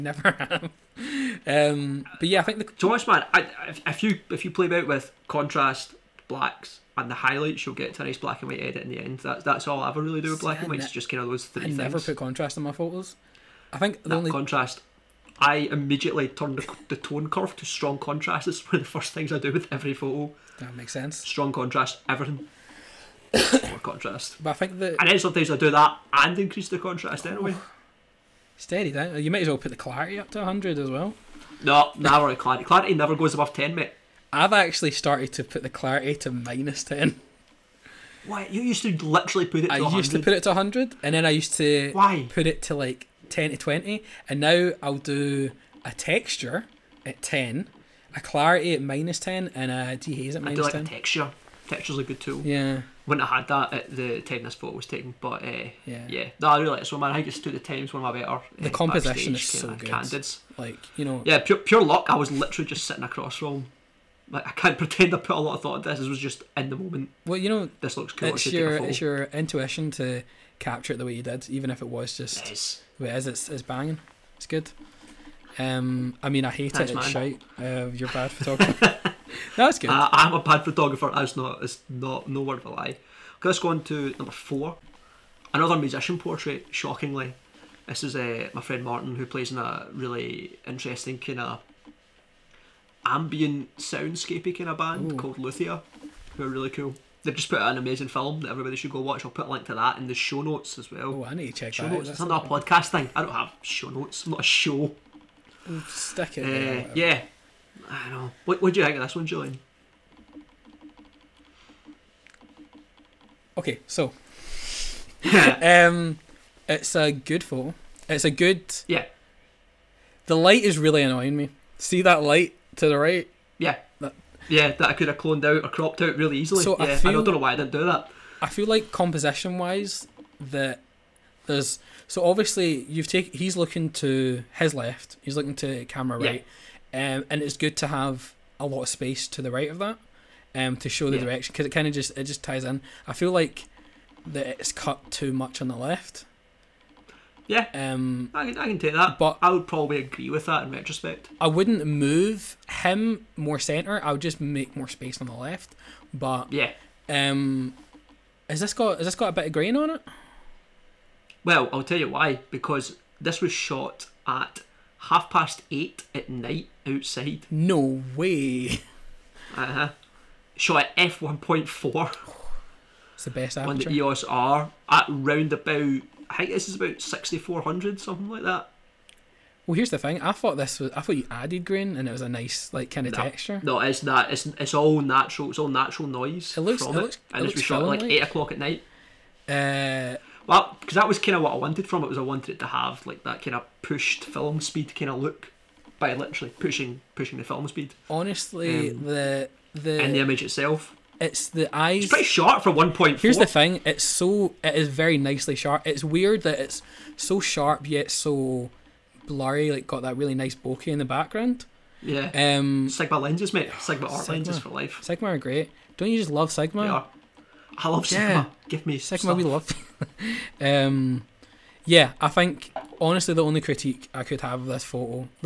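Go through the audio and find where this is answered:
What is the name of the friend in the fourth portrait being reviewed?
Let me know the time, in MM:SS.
01:28.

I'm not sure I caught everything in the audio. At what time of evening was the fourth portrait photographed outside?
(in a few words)
half past eight.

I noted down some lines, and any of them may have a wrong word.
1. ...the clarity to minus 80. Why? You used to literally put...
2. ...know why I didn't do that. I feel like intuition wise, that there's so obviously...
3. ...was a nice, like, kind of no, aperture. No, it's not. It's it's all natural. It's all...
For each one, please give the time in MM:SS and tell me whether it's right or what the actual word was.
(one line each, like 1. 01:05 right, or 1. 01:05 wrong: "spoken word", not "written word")
1. 00:35 wrong: "10", not "80"
2. 02:07 wrong: "composition", not "intuition"
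3. 03:02 wrong: "texture", not "aperture".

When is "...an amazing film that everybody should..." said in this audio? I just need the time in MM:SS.
01:37.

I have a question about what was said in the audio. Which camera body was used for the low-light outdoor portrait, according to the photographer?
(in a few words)
EOS R.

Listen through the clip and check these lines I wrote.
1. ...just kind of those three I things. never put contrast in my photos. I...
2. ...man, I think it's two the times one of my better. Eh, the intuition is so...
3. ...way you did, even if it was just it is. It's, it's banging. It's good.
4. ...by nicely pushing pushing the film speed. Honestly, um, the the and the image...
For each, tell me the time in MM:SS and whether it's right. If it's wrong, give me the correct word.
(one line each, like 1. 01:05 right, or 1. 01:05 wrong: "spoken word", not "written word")
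1. 00:10 right
2. 00:56 wrong: "composition", not "intuition"
3. 01:11 right
4. 03:15 wrong: "literally", not "nicely".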